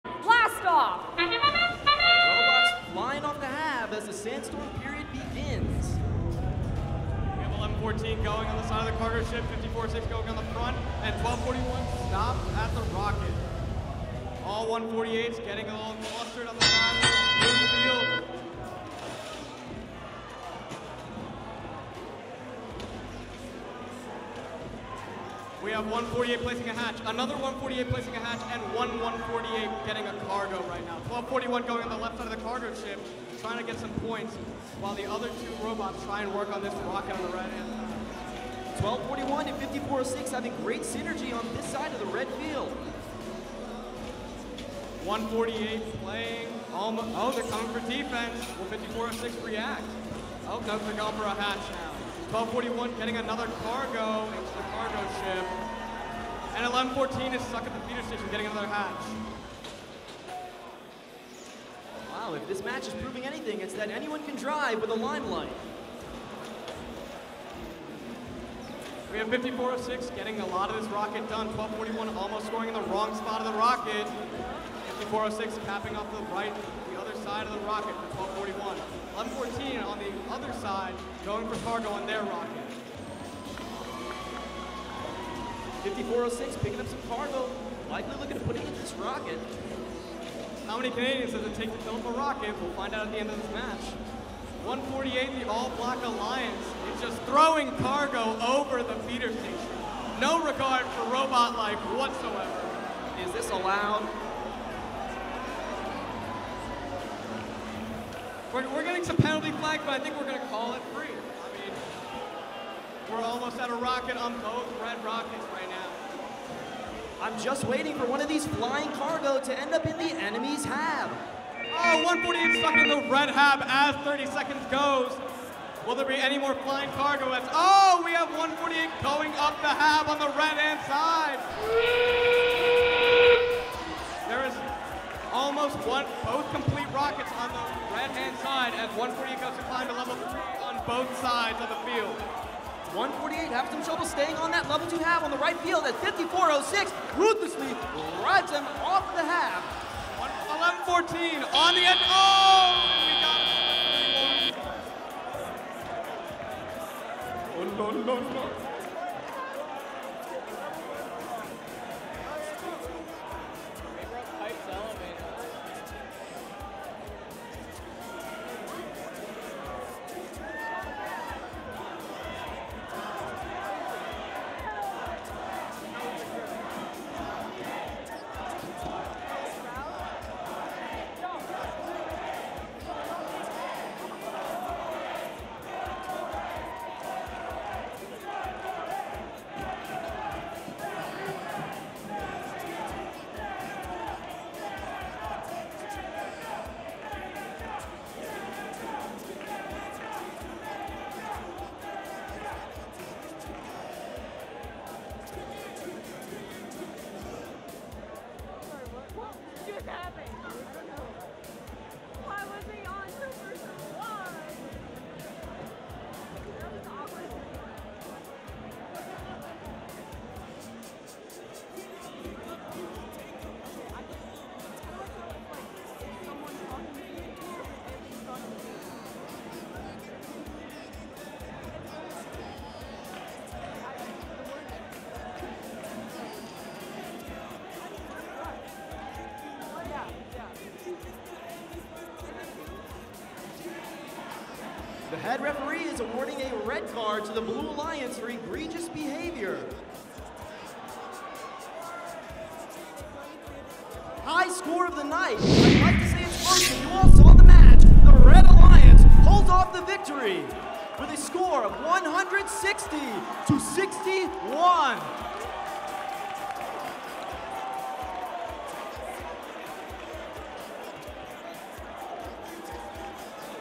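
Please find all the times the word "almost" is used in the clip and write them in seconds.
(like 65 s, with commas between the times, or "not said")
46 s, 72 s, 113 s, 135 s.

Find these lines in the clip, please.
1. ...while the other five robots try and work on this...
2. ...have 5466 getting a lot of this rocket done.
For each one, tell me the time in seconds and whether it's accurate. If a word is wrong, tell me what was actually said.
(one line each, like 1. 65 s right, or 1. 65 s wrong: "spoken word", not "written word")
1. 34 s wrong: "two", not "five"
2. 69 s wrong: "5406", not "5466".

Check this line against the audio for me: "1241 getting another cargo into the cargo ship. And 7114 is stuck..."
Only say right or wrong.
wrong.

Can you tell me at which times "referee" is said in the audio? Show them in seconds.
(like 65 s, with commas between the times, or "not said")
245 s.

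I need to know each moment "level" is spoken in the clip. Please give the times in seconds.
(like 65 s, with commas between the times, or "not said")
139 s, 144 s.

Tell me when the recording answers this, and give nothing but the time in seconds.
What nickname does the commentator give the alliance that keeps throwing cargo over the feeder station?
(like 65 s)
95 s.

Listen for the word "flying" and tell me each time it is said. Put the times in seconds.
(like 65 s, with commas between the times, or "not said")
118 s, 126 s.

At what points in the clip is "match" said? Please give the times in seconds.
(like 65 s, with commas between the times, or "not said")
62 s, 93 s, 257 s.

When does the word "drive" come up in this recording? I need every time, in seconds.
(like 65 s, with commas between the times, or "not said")
64 s.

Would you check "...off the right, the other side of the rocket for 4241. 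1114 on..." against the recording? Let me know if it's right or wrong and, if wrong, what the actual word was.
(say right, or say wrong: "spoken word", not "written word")
wrong: "1241", not "4241".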